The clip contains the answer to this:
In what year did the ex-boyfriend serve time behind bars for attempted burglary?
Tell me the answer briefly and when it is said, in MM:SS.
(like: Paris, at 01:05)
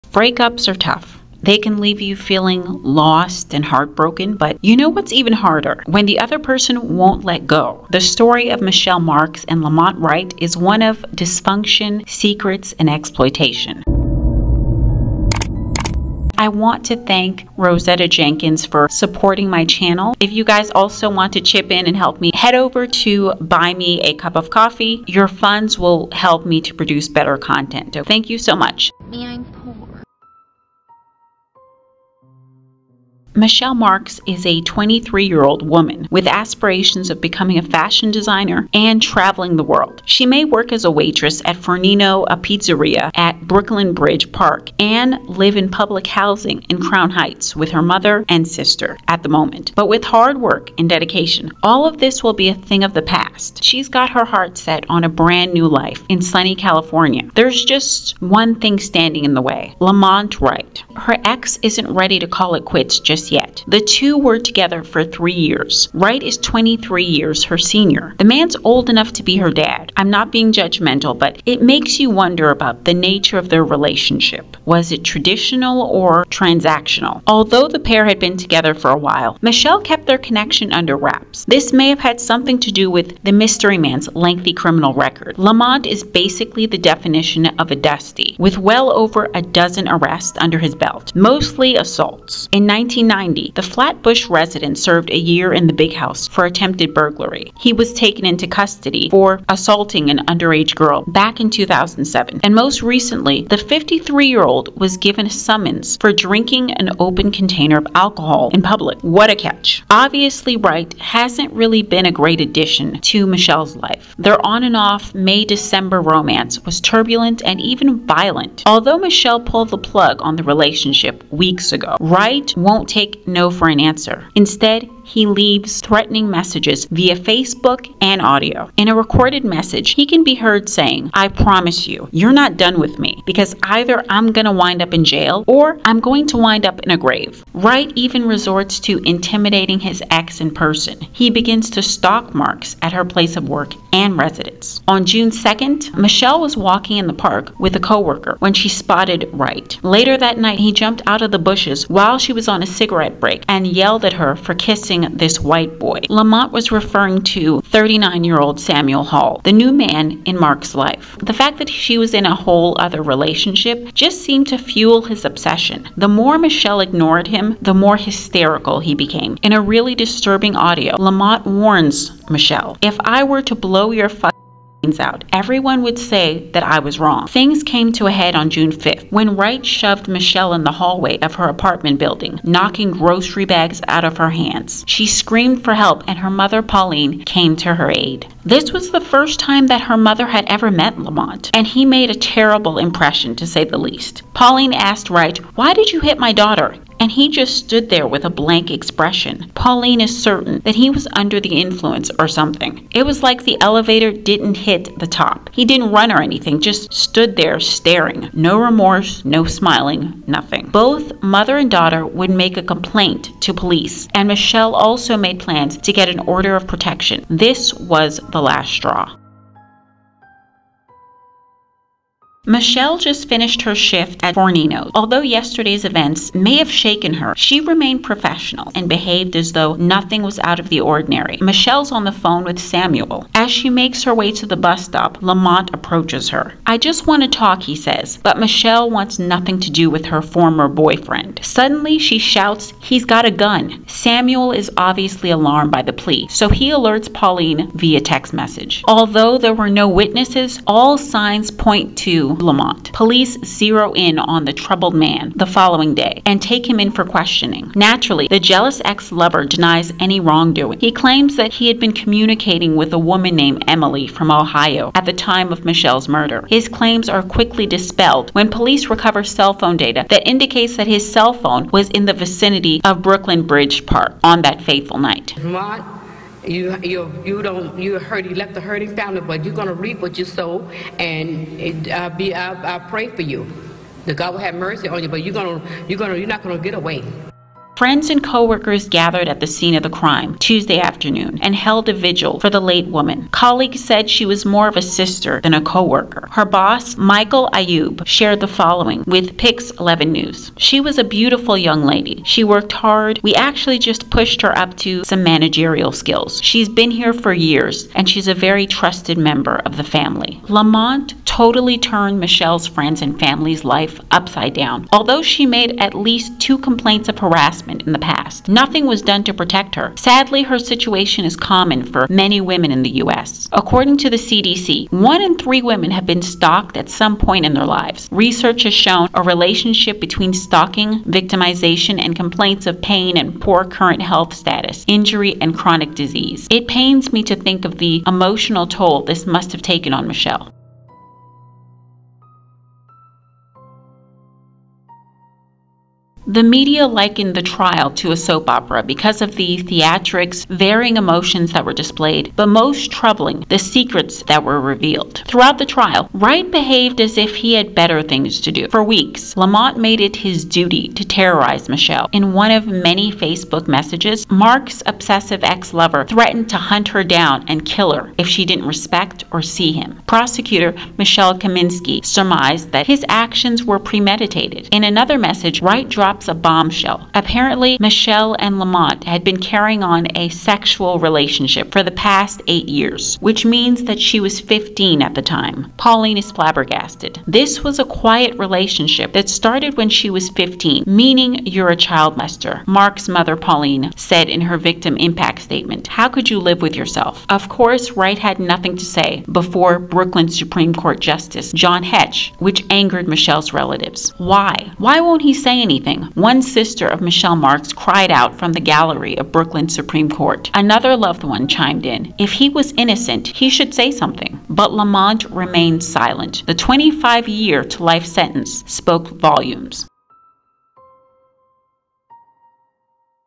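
1990, at 01:32.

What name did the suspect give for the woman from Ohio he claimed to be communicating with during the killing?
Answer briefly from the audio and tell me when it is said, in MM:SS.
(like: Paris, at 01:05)
Emily, at 04:23.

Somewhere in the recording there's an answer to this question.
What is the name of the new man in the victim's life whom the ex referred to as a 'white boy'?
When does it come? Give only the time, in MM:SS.
02:38.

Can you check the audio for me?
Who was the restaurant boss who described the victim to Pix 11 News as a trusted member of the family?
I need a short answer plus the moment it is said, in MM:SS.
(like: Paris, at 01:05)
Michael Ayoub, at 04:56.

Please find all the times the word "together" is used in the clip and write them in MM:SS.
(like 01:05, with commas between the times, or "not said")
01:04, 01:18.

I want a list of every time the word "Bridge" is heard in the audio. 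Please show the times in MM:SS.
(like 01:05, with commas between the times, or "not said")
00:43, 04:33.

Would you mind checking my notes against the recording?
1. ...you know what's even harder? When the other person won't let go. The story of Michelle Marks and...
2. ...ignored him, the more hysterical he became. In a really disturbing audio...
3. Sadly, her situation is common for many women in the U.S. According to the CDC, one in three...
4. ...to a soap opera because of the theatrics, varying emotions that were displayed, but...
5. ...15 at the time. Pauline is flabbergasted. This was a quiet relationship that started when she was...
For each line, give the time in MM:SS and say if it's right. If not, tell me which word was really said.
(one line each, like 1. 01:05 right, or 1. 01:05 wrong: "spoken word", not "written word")
1. 00:04 right
2. 02:46 right
3. 05:19 right
4. 05:47 right
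5. 06:24 right.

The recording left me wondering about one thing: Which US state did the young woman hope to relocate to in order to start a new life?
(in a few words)
California.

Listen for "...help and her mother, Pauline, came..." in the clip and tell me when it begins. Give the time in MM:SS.
03:05.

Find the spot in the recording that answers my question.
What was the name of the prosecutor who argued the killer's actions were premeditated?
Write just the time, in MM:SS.
06:10.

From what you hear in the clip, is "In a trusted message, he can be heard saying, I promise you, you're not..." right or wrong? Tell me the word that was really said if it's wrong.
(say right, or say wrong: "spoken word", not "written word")
wrong: "recorded", not "trusted".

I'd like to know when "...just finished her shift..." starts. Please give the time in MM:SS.
03:42.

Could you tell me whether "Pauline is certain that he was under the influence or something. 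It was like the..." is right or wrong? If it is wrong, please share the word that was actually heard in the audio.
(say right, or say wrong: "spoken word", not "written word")
right.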